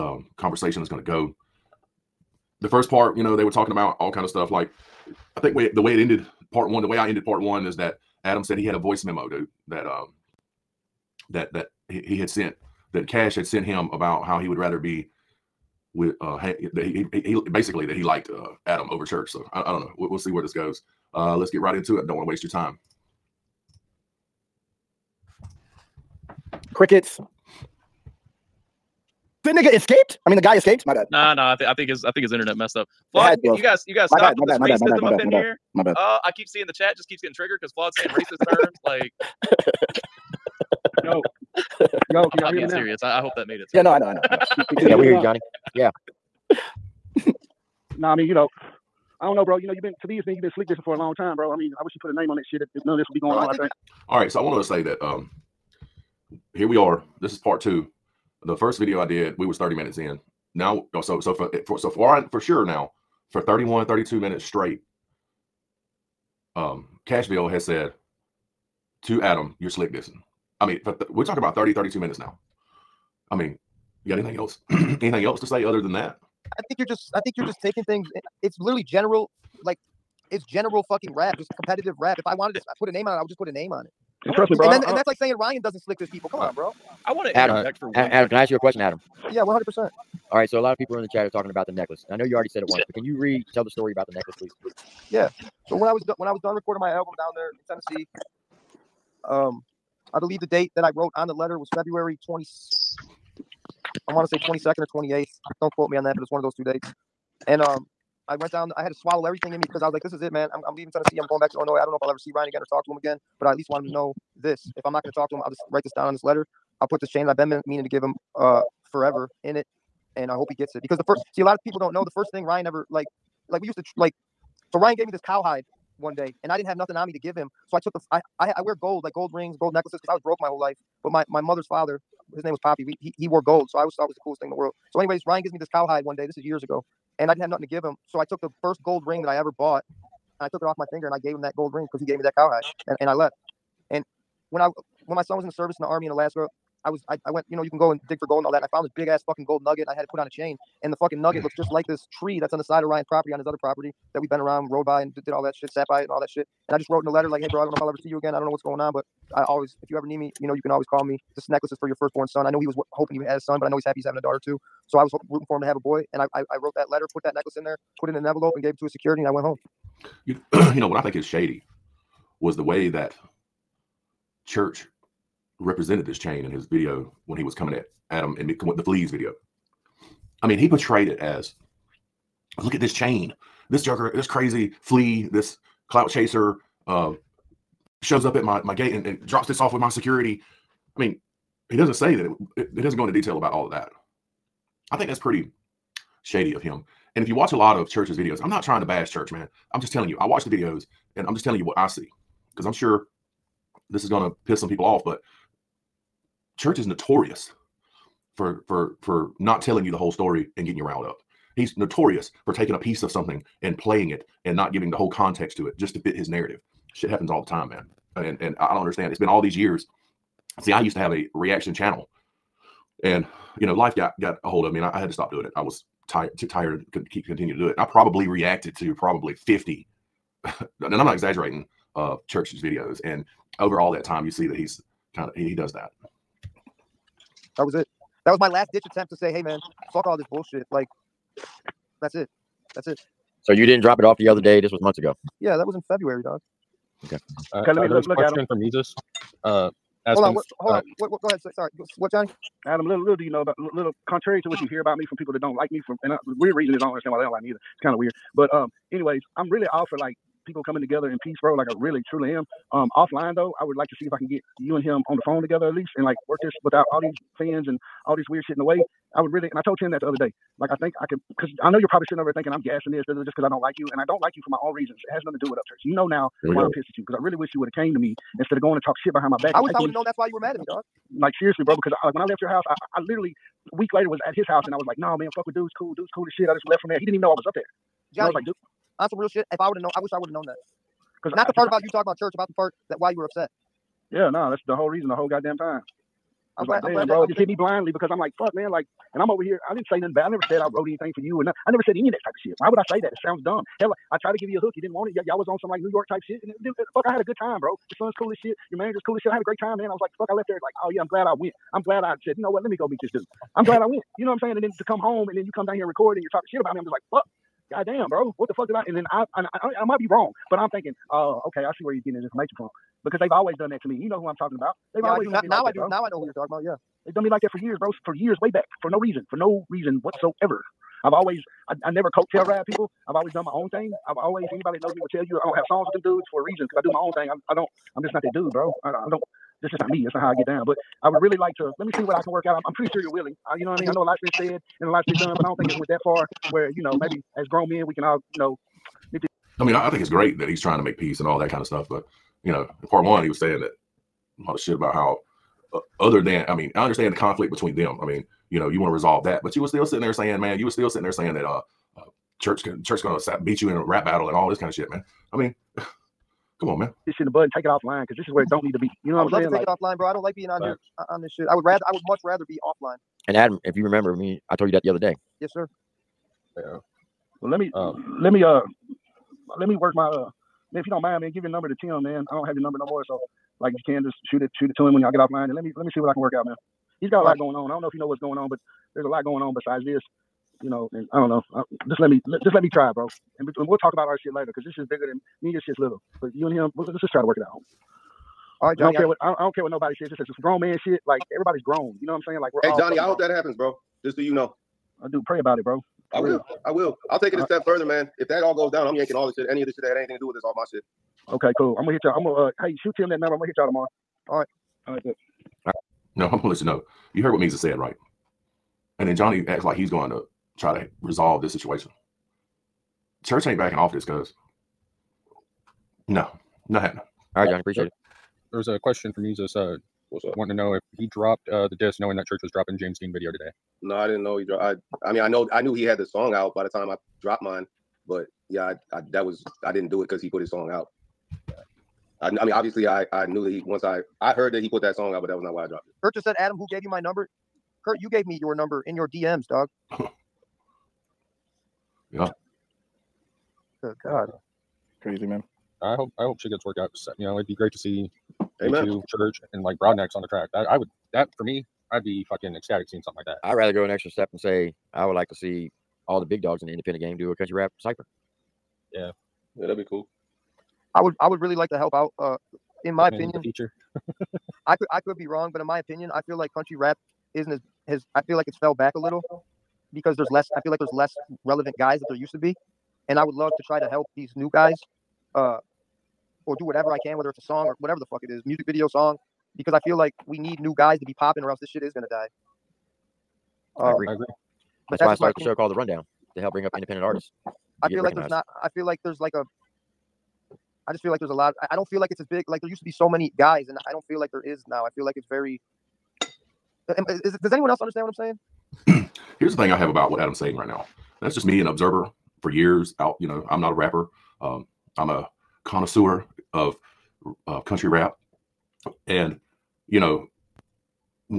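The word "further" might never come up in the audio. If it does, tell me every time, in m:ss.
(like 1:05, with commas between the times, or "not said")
6:47.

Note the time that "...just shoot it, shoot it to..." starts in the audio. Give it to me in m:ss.
6:24.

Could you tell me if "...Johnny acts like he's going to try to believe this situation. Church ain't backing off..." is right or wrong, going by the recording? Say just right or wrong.
wrong.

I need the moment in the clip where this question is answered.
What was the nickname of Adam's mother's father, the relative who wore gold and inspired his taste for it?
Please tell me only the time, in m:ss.
2:12.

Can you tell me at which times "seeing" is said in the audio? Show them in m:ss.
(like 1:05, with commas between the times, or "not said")
0:36, 7:42.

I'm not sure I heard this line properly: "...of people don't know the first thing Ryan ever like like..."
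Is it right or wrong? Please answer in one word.
right.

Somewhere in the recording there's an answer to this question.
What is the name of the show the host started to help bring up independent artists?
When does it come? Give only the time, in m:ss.
8:15.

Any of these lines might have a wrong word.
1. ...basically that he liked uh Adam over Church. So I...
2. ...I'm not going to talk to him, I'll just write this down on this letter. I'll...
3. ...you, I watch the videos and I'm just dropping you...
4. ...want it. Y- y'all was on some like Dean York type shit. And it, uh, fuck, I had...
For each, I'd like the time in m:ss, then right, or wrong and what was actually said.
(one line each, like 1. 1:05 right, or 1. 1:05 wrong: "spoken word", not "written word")
1. 0:17 right
2. 1:54 right
3. 3:20 wrong: "telling", not "dropping"
4. 5:04 wrong: "New", not "Dean".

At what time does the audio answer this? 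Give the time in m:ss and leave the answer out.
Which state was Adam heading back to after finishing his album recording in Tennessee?
1:51.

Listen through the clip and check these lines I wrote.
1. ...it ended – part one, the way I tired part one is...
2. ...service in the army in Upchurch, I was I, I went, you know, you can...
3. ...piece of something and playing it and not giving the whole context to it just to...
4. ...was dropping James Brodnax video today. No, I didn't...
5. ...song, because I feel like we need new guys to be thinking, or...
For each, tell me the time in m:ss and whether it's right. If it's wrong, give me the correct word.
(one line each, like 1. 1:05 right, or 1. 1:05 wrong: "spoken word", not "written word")
1. 0:05 wrong: "ended", not "tired"
2. 2:25 wrong: "Alaska", not "Upchurch"
3. 3:32 right
4. 7:12 wrong: "Dean", not "Brodnax"
5. 8:08 wrong: "popping", not "thinking".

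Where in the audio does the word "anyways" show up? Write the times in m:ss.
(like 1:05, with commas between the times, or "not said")
2:14, 4:18.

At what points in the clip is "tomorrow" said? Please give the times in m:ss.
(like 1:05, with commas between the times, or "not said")
6:53.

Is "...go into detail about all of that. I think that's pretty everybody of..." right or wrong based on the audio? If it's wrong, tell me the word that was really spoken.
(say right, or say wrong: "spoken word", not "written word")
wrong: "shady", not "everybody".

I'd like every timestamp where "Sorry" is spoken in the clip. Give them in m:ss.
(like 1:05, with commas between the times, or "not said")
4:11.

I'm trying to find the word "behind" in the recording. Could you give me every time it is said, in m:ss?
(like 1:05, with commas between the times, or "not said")
4:39.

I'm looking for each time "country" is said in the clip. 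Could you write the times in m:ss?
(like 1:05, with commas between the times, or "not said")
7:47, 7:56, 8:37.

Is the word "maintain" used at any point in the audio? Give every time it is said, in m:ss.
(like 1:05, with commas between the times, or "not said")
not said.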